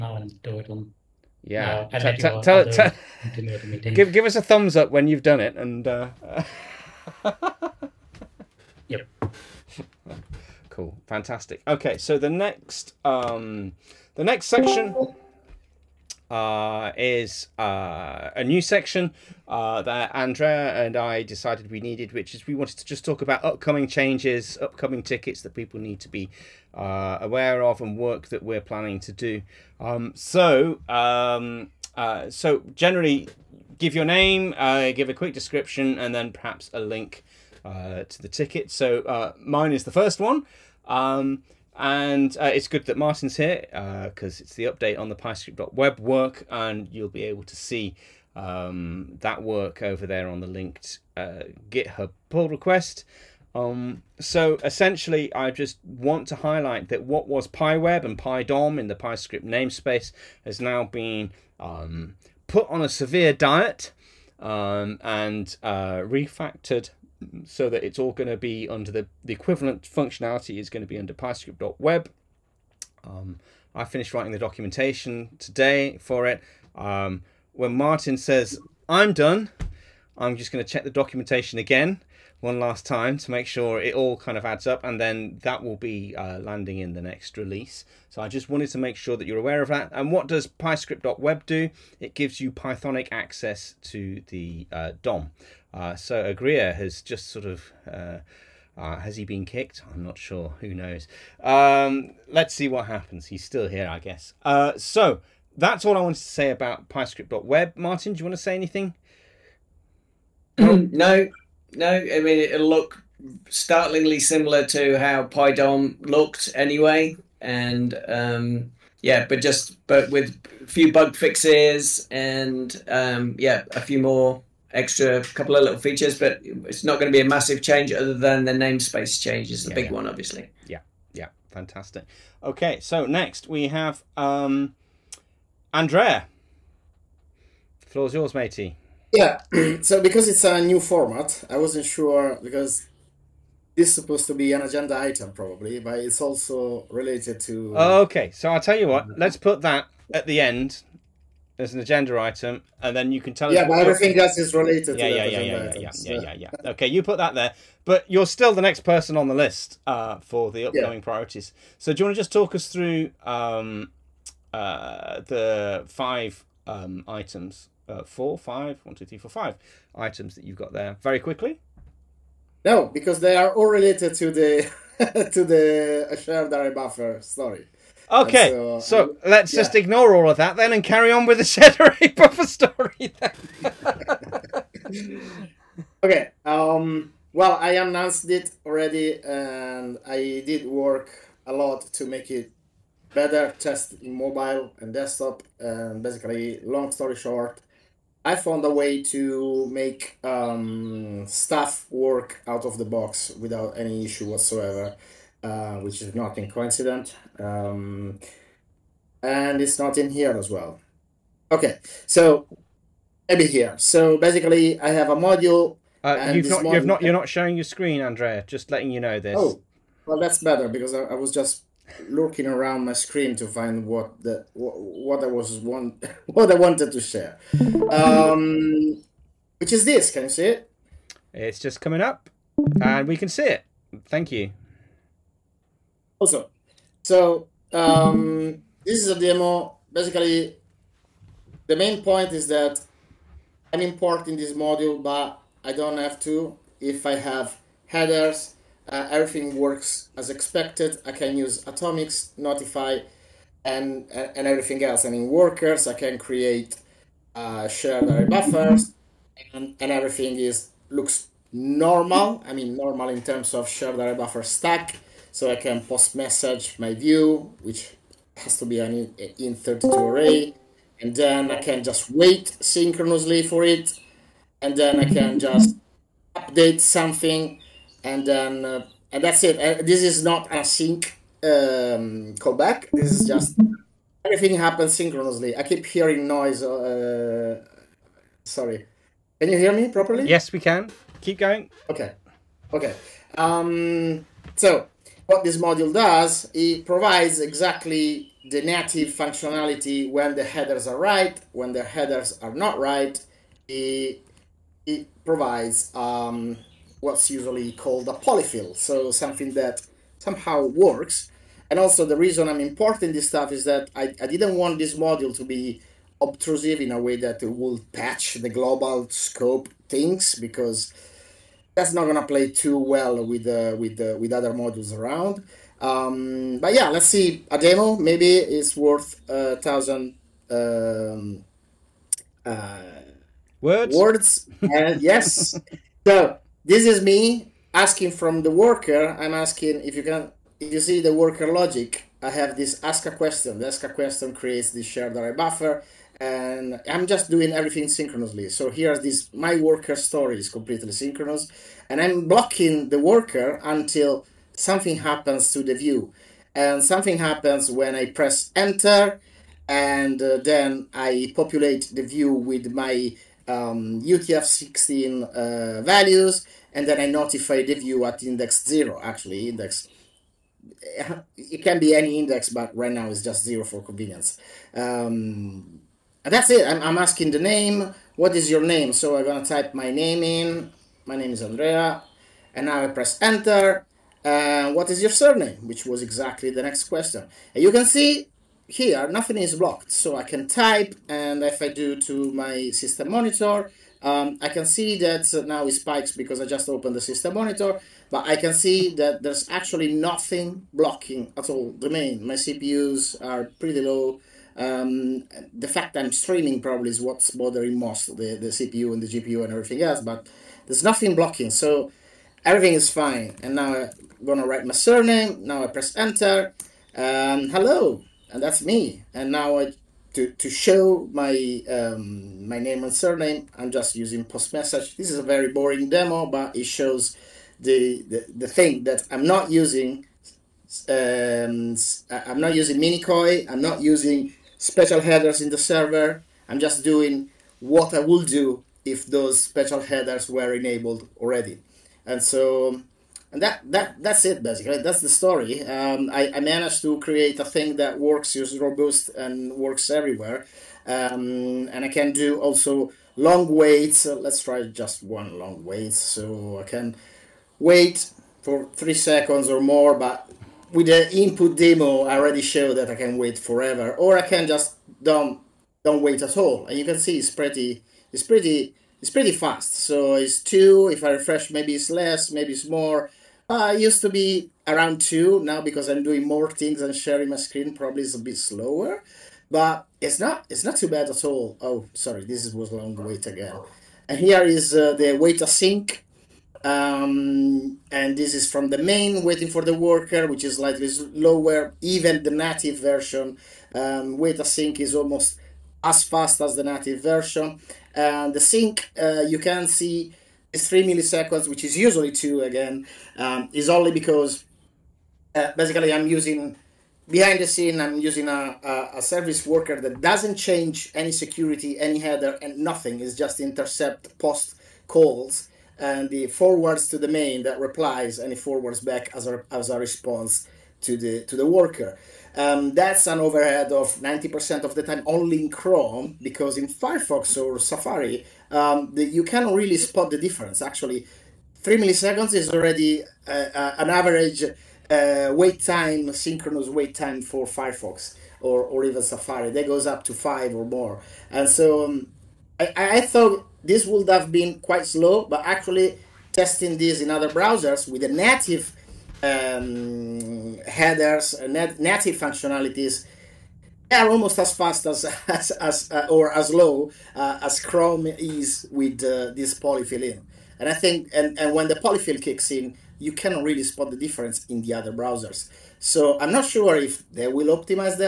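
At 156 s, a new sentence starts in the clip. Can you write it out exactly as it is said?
Okay, you put that there, but you're still the next person on the list uh, for the upcoming yeah.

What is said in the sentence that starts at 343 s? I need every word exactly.
The ask a question creates this shared array buffer and I'm just doing everything synchronously.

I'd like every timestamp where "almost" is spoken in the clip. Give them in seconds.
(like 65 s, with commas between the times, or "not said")
495 s, 554 s.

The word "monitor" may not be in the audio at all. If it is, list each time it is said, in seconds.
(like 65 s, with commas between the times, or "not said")
393 s, 397 s.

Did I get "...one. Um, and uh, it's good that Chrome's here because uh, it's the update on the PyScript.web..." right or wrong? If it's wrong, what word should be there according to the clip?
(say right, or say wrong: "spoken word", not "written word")
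wrong: "Martin", not "Chrome".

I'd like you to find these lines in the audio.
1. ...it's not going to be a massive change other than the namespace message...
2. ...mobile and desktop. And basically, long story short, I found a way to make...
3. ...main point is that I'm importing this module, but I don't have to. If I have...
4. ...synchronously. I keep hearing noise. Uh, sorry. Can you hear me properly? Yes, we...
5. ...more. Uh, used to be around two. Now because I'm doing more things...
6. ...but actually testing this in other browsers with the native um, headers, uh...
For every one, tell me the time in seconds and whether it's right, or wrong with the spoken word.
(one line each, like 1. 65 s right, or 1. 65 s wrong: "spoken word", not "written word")
1. 126 s wrong: "change", not "message"
2. 194 s right
3. 241 s right
4. 284 s right
5. 472 s right
6. 545 s right.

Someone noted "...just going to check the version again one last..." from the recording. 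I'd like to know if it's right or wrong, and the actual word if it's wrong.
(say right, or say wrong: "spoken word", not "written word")
wrong: "documentation", not "version".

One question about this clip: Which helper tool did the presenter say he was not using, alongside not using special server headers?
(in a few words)
mini-coi.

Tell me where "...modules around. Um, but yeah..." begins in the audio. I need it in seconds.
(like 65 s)
324 s.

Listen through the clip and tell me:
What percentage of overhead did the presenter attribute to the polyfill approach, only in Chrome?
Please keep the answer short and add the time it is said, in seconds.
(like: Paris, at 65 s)
90%, at 523 s.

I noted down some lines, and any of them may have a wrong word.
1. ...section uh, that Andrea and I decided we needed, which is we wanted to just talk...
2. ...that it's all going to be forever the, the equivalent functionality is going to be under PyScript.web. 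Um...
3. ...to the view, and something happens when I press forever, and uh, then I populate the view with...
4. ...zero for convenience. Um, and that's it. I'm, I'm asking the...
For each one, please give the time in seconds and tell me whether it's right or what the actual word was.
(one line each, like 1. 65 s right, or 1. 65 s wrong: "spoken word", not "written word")
1. 18 s right
2. 67 s wrong: "under", not "forever"
3. 355 s wrong: "enter", not "forever"
4. 373 s right.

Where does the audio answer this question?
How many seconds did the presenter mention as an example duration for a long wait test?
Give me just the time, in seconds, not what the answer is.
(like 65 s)
458 s.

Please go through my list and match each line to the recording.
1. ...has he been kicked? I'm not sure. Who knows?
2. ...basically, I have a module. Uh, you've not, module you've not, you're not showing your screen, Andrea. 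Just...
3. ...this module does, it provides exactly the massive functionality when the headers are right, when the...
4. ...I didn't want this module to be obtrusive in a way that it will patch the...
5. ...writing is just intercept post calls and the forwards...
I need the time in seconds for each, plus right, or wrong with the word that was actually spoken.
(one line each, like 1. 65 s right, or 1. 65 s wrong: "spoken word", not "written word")
1. 99 s right
2. 214 s right
3. 295 s wrong: "native", not "massive"
4. 314 s right
5. 512 s wrong: "nothing", not "writing".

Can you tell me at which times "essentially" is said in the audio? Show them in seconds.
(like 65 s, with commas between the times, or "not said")
54 s.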